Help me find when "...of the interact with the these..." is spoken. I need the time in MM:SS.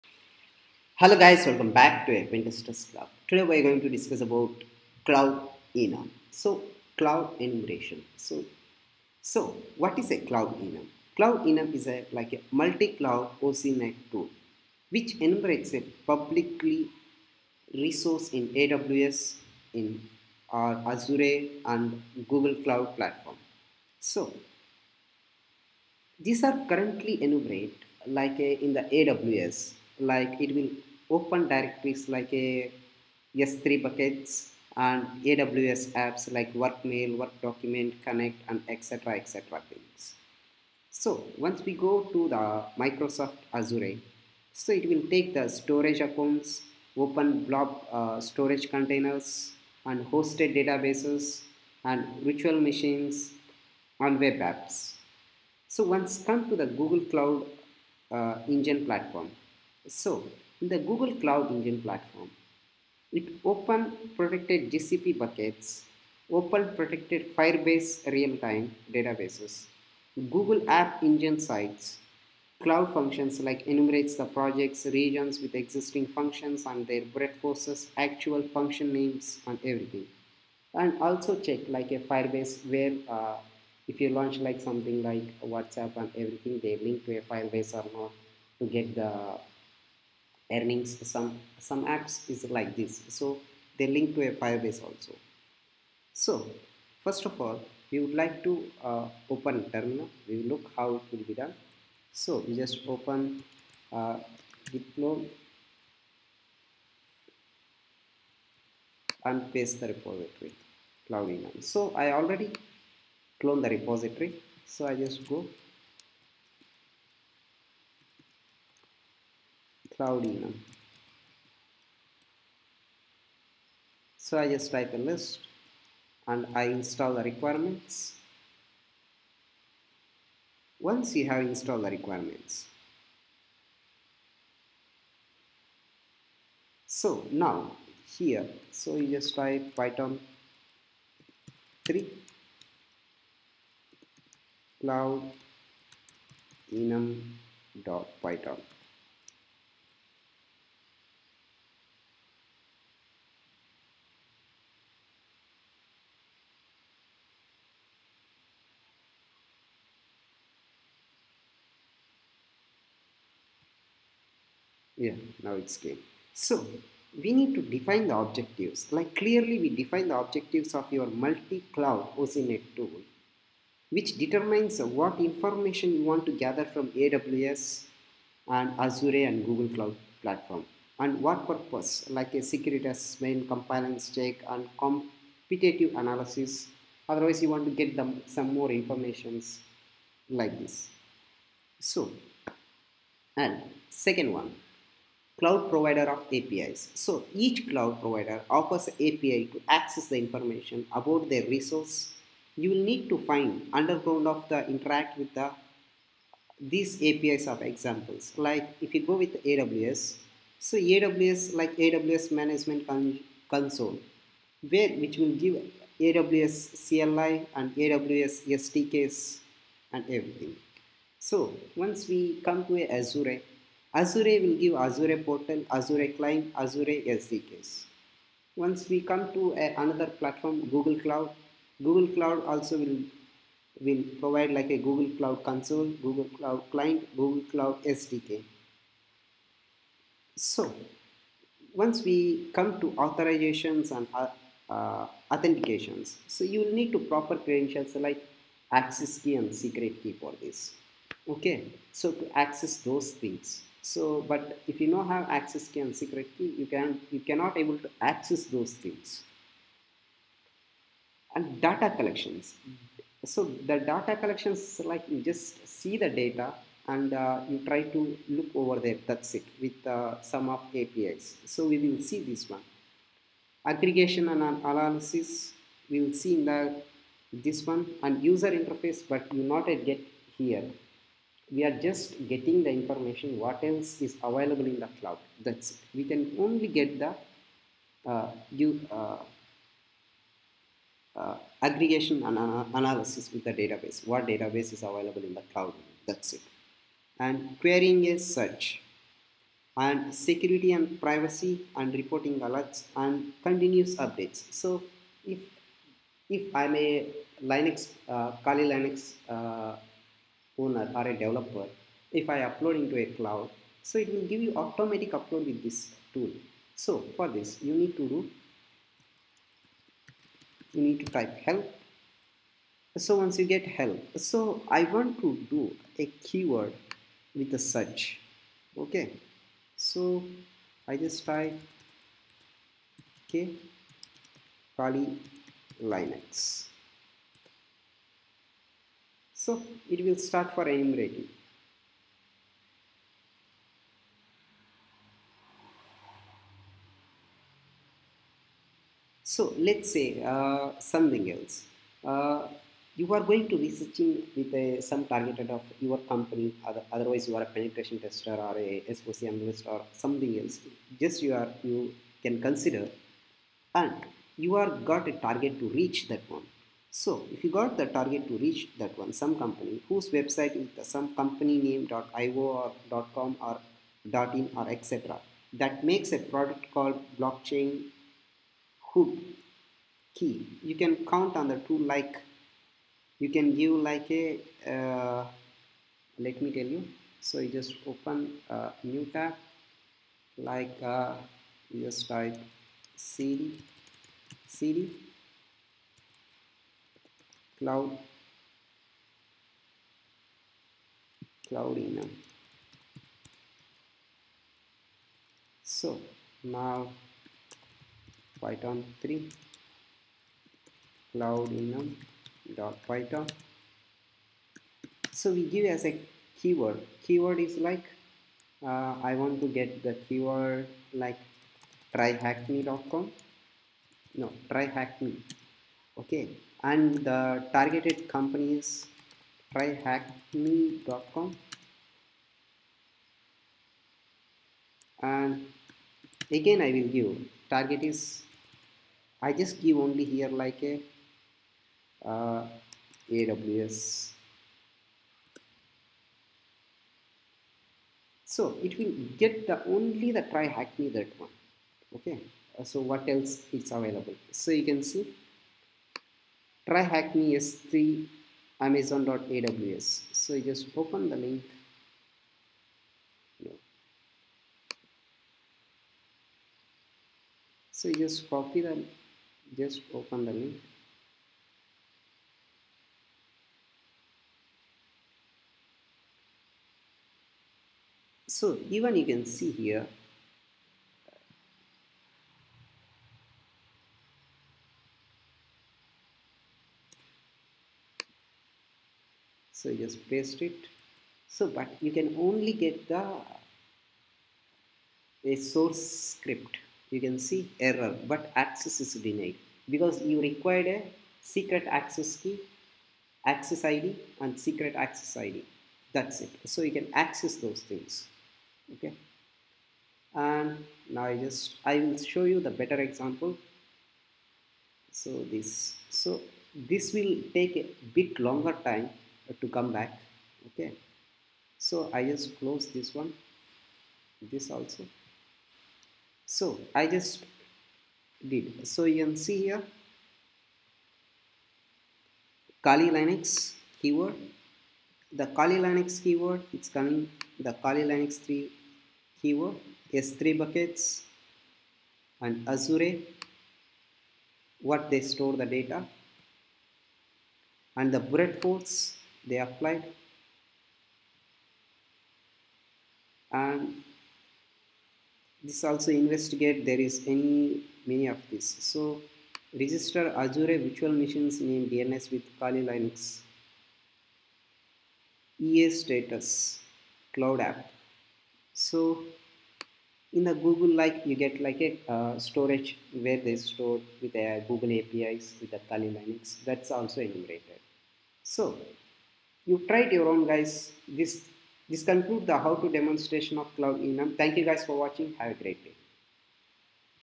03:24.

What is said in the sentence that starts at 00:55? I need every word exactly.
So once come to the Google Cloud uh, Engine platform.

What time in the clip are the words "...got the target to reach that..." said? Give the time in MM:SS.
06:07.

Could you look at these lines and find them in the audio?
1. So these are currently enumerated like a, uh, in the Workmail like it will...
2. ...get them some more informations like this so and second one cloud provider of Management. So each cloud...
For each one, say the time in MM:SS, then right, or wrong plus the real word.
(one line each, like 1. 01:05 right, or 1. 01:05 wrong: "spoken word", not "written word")
1. 00:23 wrong: "AWS", not "Workmail"
2. 03:07 wrong: "APIs", not "Management".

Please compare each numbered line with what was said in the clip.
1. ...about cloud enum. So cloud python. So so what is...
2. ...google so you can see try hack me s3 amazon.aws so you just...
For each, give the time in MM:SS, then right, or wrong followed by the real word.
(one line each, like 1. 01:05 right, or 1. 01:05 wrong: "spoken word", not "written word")
1. 00:04 wrong: "enumeration", not "python"
2. 07:33 wrong: "available", not "google".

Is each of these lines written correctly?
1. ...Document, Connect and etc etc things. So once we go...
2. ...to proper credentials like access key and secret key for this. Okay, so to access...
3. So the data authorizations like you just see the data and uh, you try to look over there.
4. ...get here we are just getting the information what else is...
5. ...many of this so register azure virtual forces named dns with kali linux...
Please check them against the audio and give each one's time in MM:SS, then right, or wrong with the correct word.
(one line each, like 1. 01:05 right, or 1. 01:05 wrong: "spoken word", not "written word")
1. 00:37 right
2. 04:06 right
3. 04:23 wrong: "collections", not "authorizations"
4. 04:39 right
5. 09:17 wrong: "machines", not "forces".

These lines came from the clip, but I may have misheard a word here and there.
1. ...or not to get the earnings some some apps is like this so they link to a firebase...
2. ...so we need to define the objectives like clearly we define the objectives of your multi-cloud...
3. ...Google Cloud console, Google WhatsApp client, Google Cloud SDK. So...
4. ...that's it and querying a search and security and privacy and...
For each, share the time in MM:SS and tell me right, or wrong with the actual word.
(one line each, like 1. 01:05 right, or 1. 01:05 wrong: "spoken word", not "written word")
1. 01:27 right
2. 02:46 right
3. 03:54 wrong: "Cloud", not "WhatsApp"
4. 04:56 right.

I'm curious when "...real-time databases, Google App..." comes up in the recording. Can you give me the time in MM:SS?
01:08.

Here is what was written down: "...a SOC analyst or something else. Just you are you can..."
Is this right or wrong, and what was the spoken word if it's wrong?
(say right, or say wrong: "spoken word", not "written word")
right.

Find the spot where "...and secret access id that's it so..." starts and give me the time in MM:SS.
08:24.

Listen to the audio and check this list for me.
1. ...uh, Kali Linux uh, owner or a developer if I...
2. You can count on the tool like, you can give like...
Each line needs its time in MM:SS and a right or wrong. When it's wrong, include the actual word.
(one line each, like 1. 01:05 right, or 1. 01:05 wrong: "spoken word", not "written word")
1. 05:08 right
2. 06:20 right.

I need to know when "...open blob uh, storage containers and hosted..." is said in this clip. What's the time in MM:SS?
00:46.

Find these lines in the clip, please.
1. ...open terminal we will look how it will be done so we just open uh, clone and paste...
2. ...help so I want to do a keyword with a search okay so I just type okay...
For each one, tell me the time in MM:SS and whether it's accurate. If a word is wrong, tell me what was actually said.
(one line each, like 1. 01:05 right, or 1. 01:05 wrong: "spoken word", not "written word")
1. 01:39 right
2. 05:23 right.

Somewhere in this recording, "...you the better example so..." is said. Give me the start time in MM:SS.
08:32.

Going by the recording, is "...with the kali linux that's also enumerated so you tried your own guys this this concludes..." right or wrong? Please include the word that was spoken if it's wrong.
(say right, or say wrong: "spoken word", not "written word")
right.